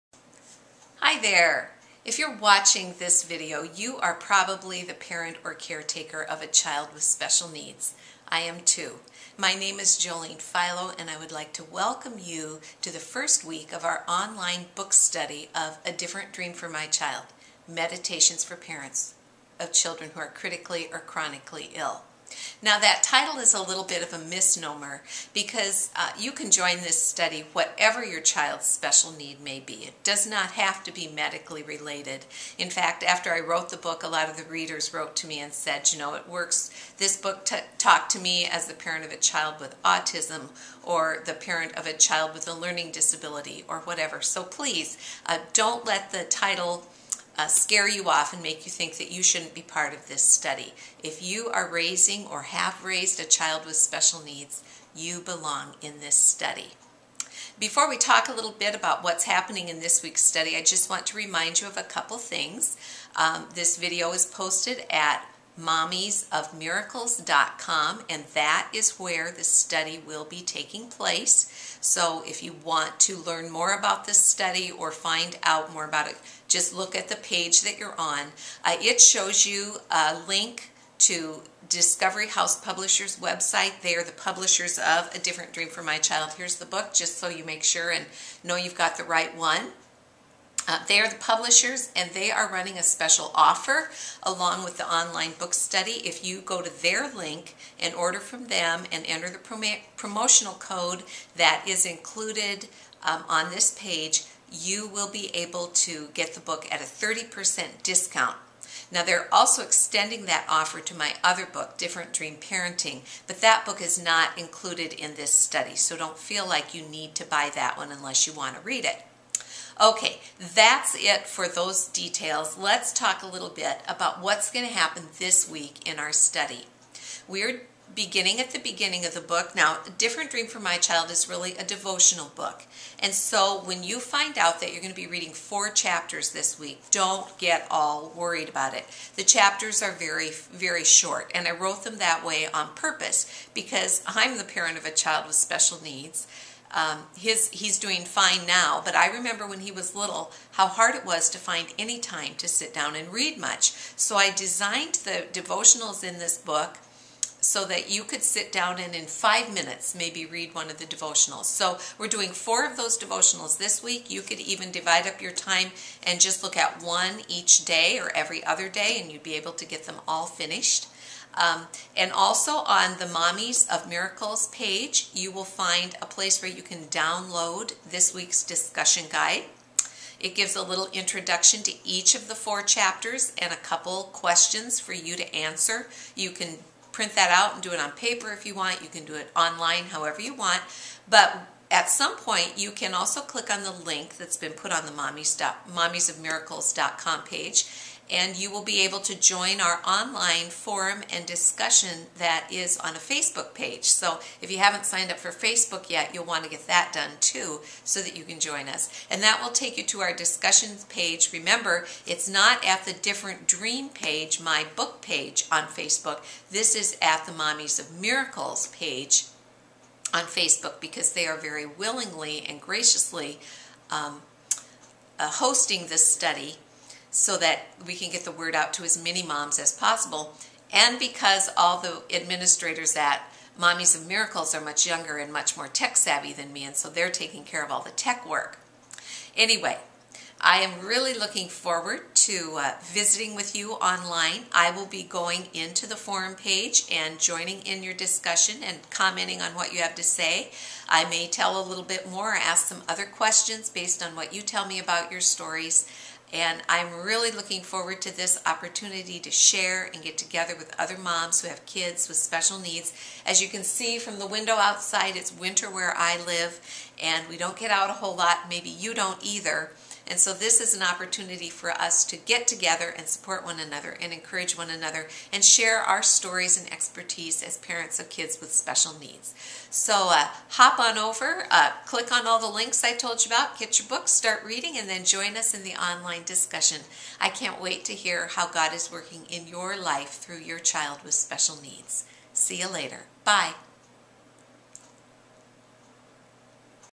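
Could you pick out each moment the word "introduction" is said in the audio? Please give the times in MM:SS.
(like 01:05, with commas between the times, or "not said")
03:00.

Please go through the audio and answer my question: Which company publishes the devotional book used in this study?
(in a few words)
Discovery House Publishers.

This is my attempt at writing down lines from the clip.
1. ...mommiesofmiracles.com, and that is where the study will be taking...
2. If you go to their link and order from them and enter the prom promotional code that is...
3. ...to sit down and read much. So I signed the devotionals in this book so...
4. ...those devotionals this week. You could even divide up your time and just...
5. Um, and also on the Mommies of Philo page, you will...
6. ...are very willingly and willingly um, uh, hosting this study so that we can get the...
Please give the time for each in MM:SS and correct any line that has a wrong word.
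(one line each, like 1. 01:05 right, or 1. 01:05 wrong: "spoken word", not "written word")
1. 01:05 right
2. 01:36 right
3. 02:32 wrong: "designed", not "signed"
4. 02:42 right
5. 02:51 wrong: "Miracles", not "Philo"
6. 03:41 wrong: "graciously", not "willingly".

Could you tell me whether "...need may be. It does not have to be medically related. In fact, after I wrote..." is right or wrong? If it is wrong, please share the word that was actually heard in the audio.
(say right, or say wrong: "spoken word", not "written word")
right.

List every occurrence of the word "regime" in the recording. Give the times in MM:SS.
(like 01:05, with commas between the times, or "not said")
not said.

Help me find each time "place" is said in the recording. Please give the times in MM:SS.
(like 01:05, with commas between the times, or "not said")
01:10, 02:56.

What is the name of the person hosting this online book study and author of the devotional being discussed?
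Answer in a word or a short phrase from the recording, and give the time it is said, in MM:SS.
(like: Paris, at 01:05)
Jolene Philo, at 00:09.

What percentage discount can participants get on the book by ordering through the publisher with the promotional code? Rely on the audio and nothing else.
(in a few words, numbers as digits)
30%.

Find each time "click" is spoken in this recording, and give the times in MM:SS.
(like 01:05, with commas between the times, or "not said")
03:13, 04:41.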